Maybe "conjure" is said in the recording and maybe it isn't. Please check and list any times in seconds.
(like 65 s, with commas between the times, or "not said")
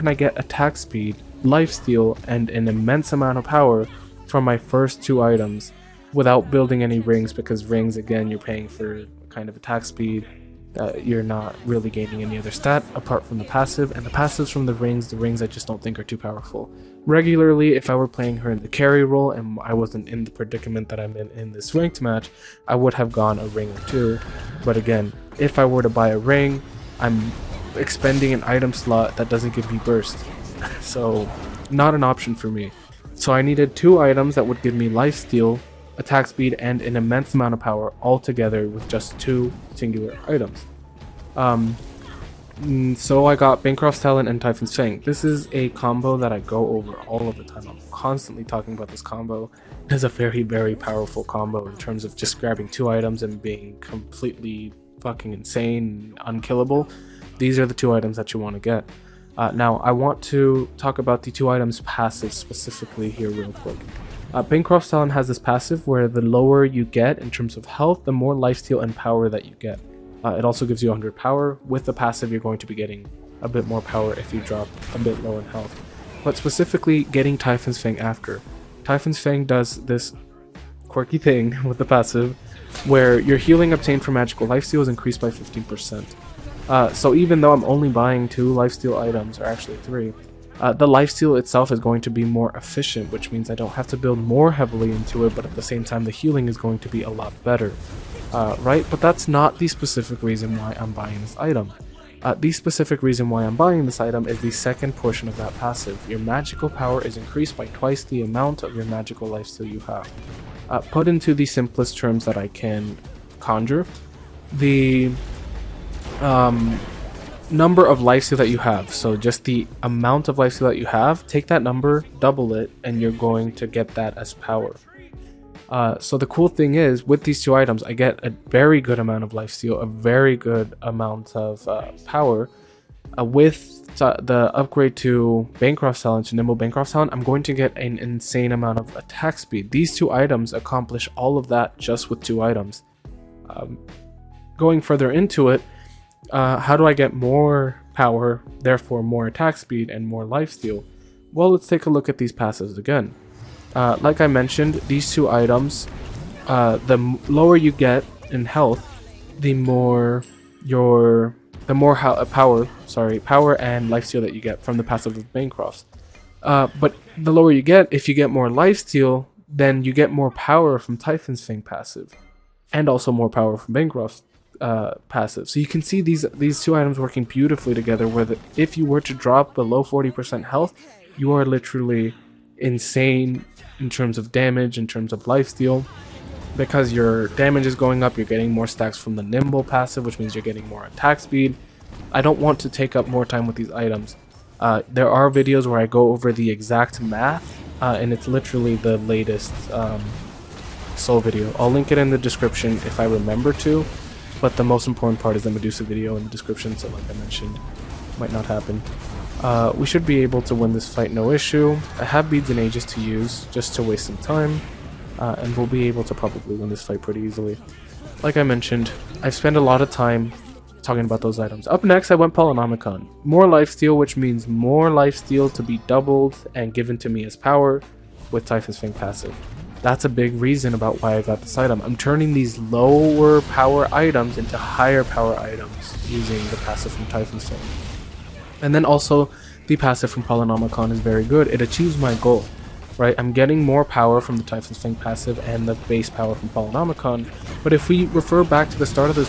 113 s.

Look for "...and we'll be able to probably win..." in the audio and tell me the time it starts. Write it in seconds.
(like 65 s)
215 s.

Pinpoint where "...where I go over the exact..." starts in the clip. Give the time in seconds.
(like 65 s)
195 s.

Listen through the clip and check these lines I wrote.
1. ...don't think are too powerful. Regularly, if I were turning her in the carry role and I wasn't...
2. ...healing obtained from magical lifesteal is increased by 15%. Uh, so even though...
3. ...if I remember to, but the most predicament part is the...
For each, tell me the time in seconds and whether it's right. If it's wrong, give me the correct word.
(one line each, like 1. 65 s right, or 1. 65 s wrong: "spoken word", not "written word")
1. 15 s wrong: "playing", not "turning"
2. 83 s right
3. 202 s wrong: "important", not "predicament".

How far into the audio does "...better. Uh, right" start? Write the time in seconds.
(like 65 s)
97 s.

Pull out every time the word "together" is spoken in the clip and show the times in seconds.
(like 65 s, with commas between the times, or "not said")
38 s, 177 s.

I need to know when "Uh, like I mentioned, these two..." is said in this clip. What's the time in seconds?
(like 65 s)
153 s.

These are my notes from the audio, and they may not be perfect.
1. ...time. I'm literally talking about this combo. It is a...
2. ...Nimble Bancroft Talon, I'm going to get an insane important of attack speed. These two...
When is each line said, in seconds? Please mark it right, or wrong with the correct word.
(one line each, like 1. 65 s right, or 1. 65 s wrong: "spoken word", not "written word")
1. 47 s wrong: "constantly", not "literally"
2. 136 s wrong: "amount", not "important".